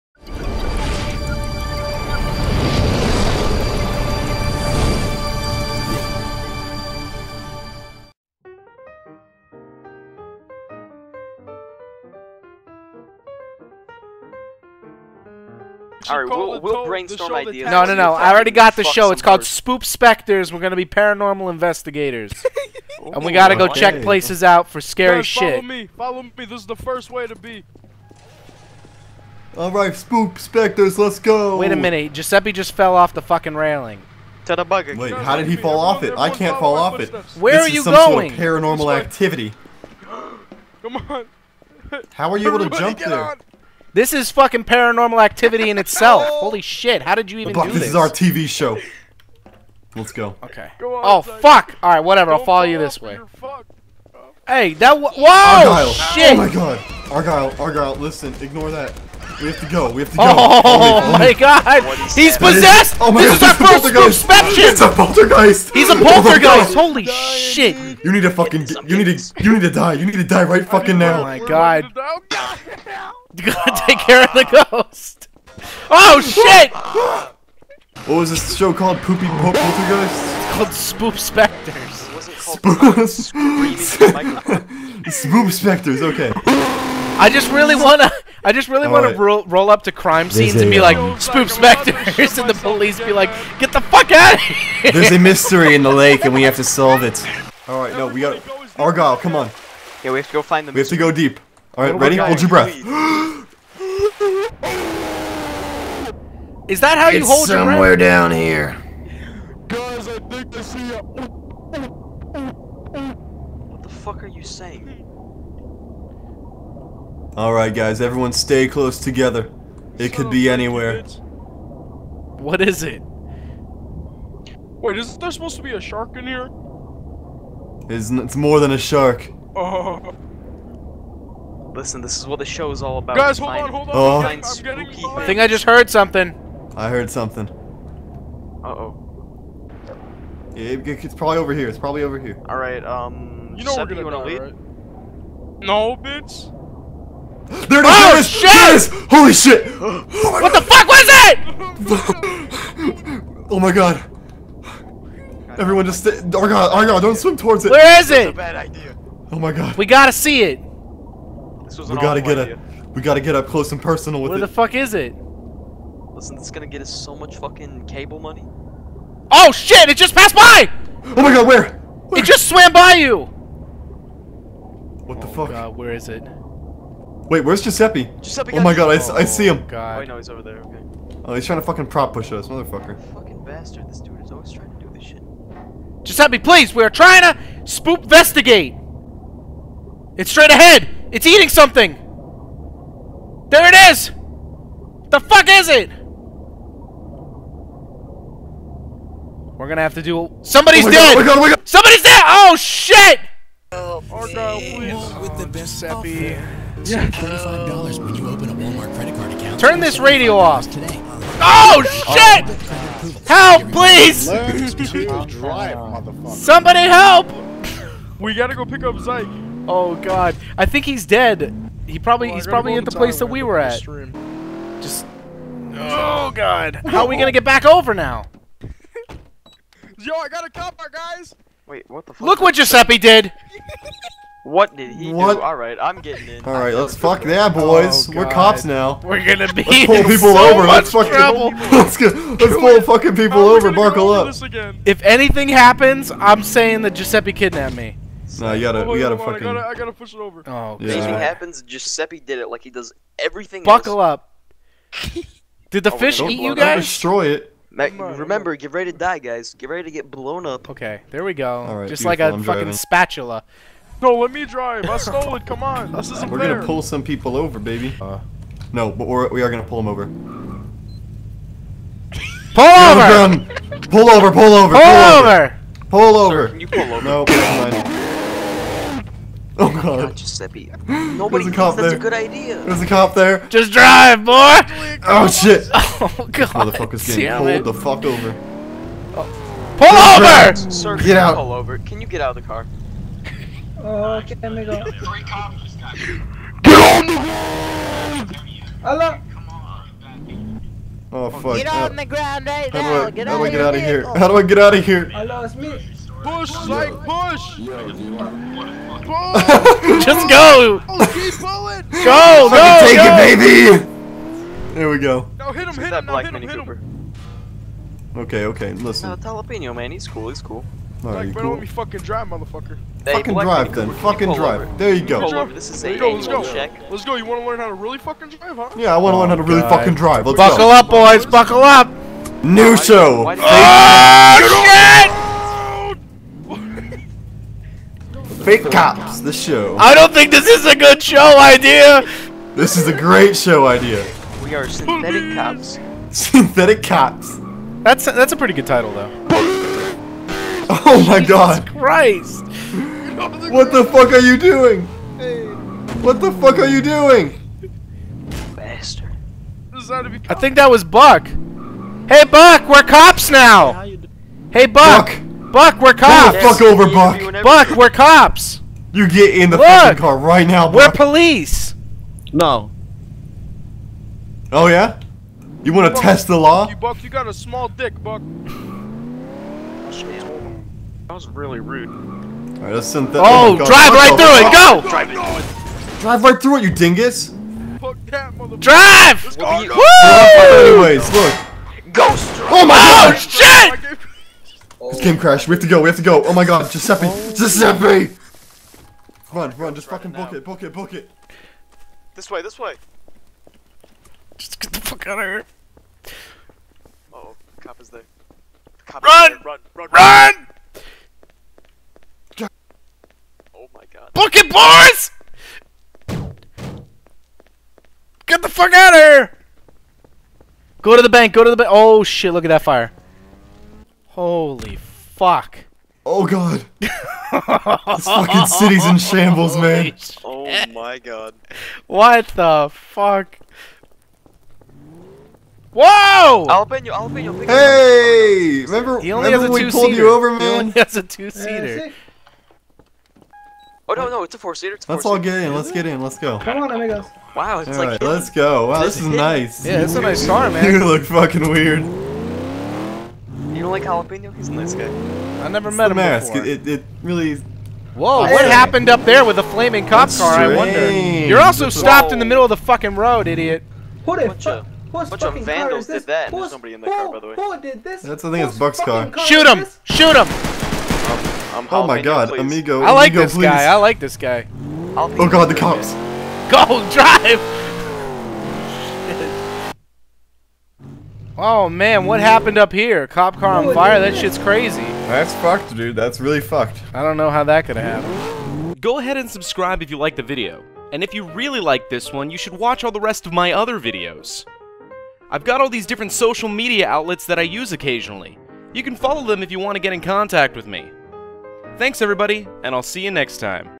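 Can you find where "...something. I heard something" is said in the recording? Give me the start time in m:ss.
2:15.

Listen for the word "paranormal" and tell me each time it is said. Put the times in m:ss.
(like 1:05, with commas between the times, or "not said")
0:20, 0:38, 0:44.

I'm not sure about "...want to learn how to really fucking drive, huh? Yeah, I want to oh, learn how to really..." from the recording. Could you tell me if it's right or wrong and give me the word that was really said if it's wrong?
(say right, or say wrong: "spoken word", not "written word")
right.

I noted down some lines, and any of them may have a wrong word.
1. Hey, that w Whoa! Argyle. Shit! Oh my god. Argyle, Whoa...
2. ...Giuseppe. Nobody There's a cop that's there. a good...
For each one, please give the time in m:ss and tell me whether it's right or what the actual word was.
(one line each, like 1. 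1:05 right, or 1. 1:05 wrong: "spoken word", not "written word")
1. 0:54 wrong: "Argyle", not "Whoa"
2. 4:40 right.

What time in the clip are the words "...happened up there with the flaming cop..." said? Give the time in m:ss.
7:38.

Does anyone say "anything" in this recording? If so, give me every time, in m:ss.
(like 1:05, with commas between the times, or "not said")
4:05, 4:10.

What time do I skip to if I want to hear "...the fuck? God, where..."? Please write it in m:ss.
2:55.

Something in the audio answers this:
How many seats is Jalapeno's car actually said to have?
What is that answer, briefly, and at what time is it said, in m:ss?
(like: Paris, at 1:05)
4, at 7:24.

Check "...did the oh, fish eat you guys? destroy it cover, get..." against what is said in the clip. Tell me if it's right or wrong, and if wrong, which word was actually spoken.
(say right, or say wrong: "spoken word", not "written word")
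wrong: "remember", not "cover".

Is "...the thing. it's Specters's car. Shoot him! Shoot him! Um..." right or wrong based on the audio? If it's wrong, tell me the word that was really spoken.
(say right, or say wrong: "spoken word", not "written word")
wrong: "Buck", not "Specters".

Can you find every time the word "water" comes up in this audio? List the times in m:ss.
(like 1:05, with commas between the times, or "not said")
not said.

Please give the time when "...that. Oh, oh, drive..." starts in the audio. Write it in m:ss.
6:23.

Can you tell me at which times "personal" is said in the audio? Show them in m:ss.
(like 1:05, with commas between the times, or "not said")
2:43.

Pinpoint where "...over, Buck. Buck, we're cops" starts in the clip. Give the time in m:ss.
6:06.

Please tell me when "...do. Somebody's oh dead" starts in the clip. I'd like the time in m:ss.
3:20.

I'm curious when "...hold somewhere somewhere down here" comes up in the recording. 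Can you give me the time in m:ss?
1:47.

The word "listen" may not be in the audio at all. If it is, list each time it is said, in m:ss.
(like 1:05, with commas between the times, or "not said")
0:57, 2:11, 2:46, 5:18.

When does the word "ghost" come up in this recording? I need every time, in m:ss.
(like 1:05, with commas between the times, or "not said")
1:14, 6:31.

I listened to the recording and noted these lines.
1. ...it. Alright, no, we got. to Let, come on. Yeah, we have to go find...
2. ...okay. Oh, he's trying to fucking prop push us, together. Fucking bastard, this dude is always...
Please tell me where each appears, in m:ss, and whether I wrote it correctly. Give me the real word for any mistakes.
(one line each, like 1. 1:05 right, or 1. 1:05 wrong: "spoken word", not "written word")
1. 1:37 wrong: "Argyle", not "Let"
2. 3:00 wrong: "motherfucker", not "together".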